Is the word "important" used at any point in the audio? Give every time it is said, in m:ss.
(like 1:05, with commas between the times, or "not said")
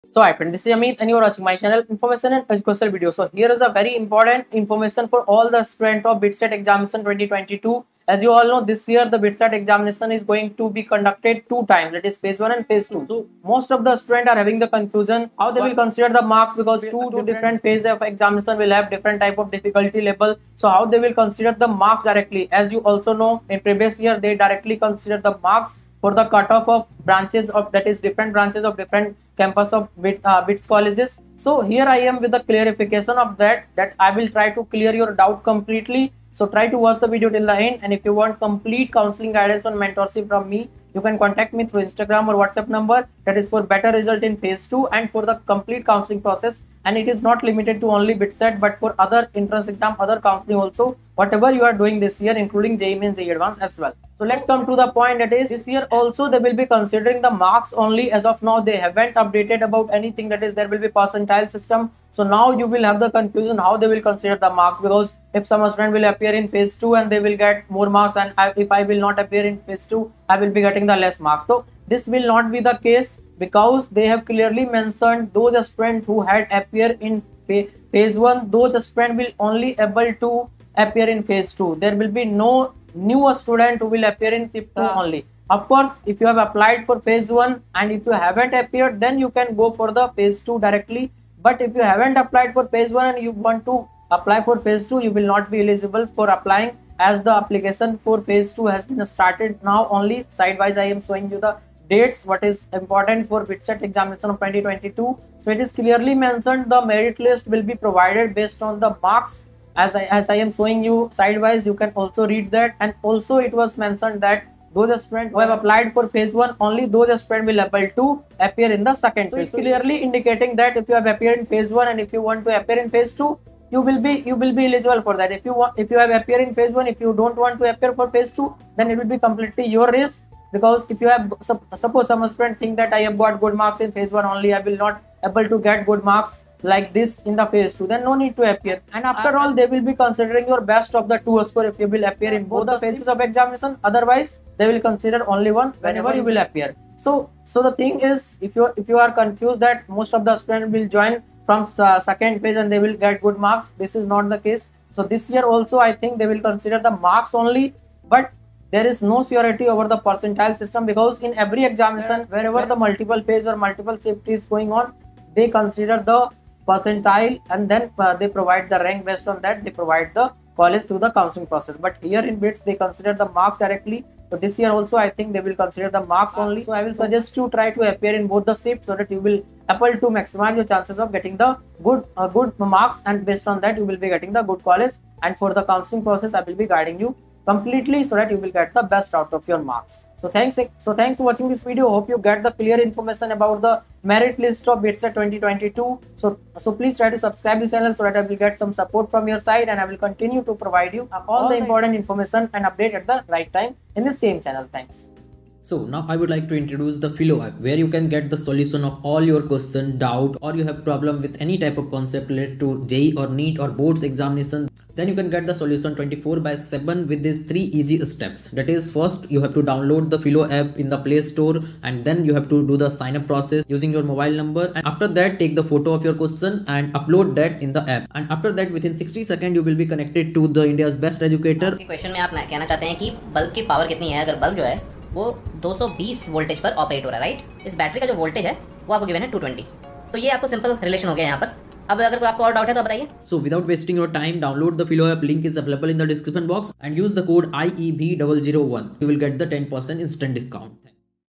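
0:03, 1:42, 3:21.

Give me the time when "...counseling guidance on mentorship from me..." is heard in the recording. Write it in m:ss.
0:38.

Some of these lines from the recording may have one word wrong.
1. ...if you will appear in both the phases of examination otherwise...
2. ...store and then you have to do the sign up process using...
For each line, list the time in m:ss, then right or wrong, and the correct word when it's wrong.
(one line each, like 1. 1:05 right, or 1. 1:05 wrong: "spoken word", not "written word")
1. 2:21 right
2. 3:41 right.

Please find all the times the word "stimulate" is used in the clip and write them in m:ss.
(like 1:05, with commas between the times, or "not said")
not said.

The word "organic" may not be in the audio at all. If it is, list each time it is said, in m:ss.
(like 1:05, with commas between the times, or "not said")
not said.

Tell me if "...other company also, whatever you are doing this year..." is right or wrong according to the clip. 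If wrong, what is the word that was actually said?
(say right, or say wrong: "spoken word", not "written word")
right.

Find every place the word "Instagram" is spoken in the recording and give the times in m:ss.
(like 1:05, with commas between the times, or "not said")
0:41.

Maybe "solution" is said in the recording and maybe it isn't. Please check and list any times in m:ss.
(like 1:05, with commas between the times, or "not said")
3:28, 3:35.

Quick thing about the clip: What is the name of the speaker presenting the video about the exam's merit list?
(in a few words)
Amit.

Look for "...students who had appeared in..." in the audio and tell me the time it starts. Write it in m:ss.
1:15.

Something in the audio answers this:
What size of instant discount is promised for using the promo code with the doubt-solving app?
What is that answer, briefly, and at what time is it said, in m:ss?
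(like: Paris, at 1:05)
10 percent, at 4:09.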